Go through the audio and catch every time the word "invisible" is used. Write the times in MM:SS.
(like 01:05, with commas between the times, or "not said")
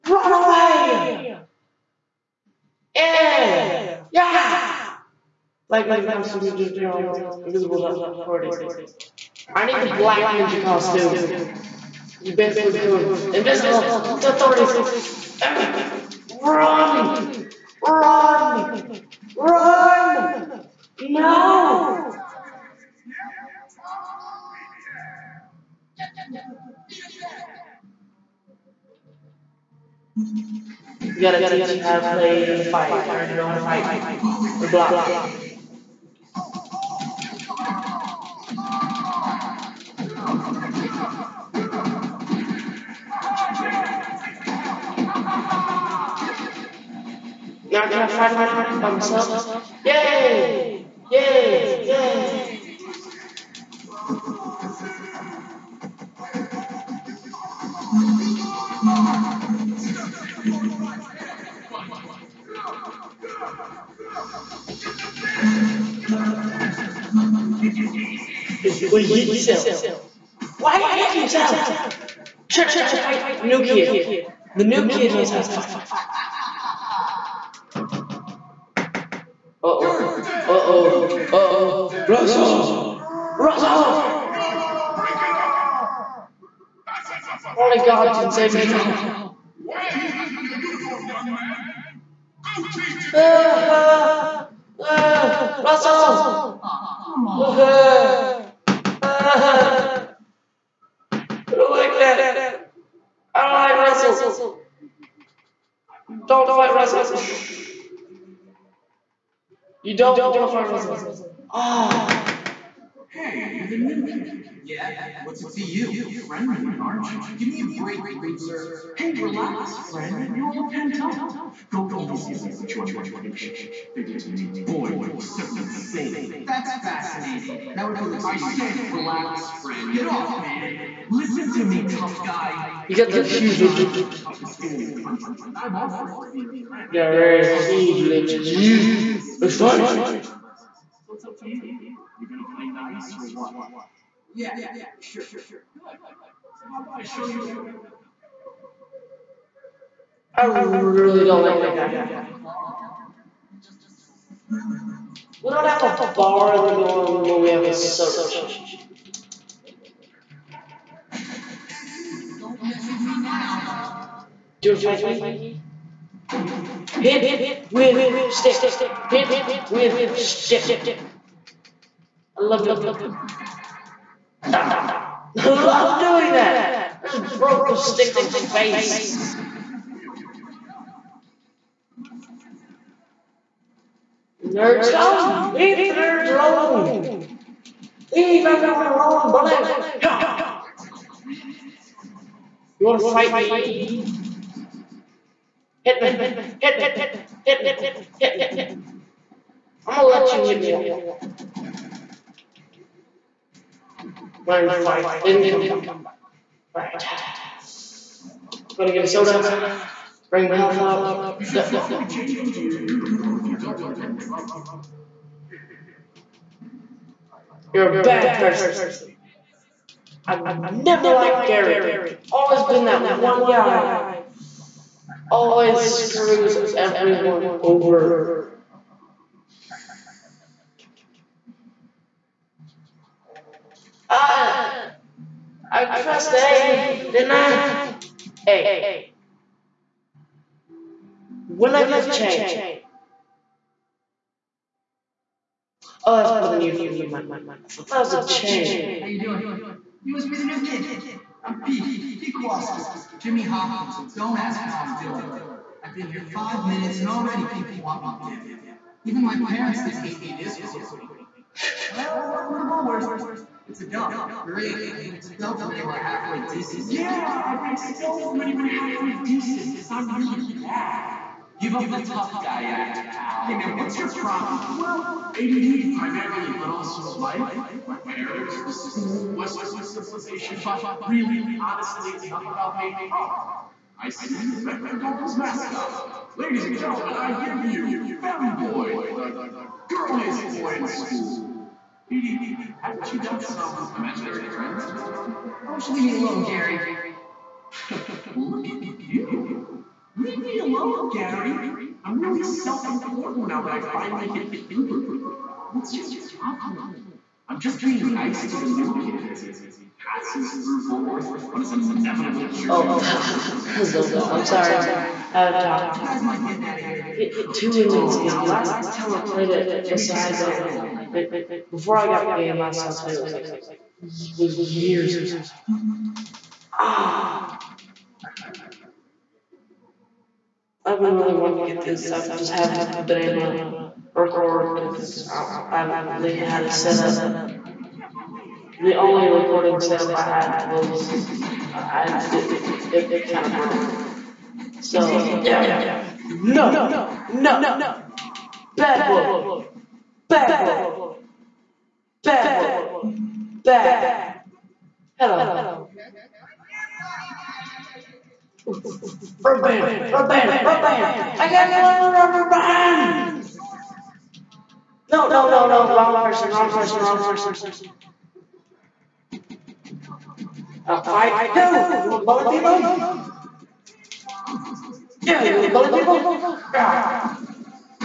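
00:07, 00:13.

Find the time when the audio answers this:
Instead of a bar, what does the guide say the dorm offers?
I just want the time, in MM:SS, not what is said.
02:37.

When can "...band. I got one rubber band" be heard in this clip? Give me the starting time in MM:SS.
06:00.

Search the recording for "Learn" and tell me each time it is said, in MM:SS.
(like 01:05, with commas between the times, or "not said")
03:24.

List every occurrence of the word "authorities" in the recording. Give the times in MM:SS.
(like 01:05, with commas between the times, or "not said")
00:08, 00:14.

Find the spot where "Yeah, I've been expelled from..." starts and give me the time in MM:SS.
04:26.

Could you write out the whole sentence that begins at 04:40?
But really, honestly, enough about me.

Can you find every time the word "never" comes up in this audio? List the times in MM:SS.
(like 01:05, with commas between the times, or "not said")
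03:40, 04:06.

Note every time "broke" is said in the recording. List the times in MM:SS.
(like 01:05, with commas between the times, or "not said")
02:57, 05:43.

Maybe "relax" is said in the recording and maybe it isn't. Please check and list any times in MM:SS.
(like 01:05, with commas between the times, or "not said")
01:59, 02:08.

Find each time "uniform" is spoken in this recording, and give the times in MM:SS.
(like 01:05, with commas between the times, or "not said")
01:30, 03:32, 04:06.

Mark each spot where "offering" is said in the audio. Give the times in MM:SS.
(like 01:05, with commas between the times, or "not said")
02:15.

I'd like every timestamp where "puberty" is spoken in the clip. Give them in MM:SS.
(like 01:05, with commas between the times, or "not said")
05:04.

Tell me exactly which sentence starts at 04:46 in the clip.
Ladies and gentlemen, I give you Femboy, the girliest boy in school.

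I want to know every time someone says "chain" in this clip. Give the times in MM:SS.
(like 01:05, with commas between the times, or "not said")
04:02, 04:08.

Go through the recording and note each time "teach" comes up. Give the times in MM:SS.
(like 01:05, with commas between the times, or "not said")
00:31, 01:32.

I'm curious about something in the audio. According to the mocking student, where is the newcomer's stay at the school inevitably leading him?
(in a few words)
prison.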